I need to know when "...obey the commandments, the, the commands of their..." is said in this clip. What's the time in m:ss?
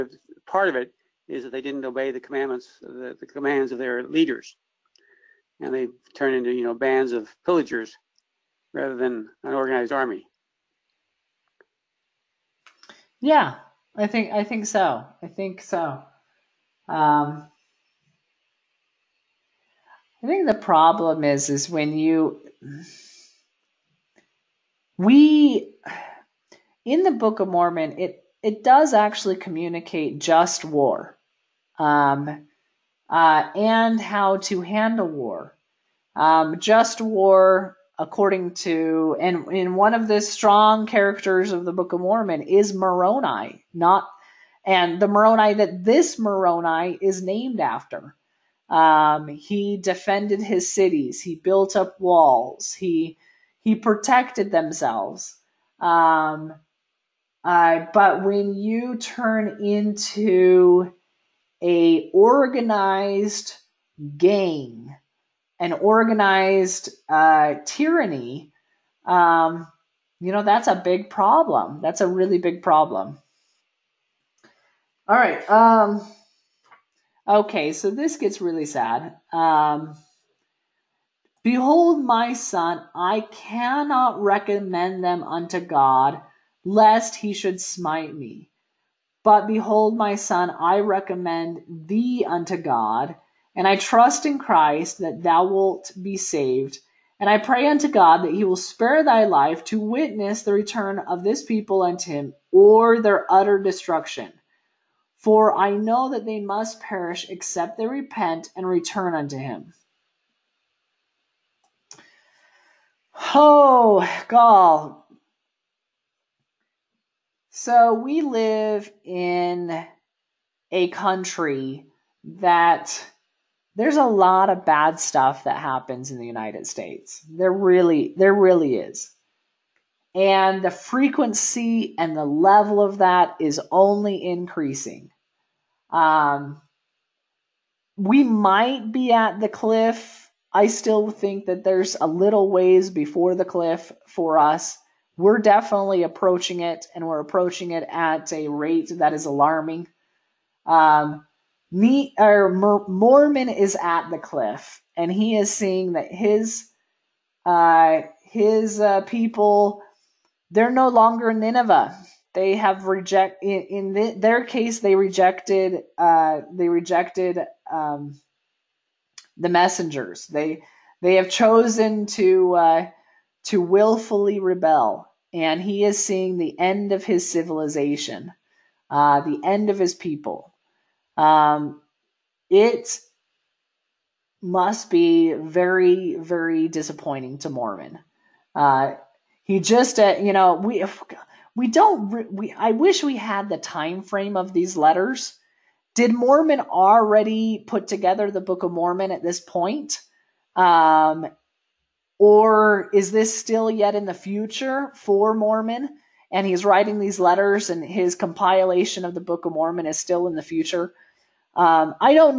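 0:01.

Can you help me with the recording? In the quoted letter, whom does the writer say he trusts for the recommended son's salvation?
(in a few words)
Christ.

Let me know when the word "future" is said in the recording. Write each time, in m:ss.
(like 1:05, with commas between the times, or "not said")
3:24, 3:30.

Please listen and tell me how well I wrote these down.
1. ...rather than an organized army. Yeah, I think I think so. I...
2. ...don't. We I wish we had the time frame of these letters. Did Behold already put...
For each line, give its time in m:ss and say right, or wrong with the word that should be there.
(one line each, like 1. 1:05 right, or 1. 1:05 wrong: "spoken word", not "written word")
1. 0:08 right
2. 3:11 wrong: "Mormon", not "Behold".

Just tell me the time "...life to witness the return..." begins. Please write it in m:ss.
1:39.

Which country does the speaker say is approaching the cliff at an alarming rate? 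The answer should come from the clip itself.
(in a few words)
United States.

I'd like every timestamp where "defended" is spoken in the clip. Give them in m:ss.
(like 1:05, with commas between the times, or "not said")
0:49.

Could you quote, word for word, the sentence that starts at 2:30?
Um, me, or Mormon is at the cliff and he is seeing that his uh, his uh, people they're no longer Nineveh.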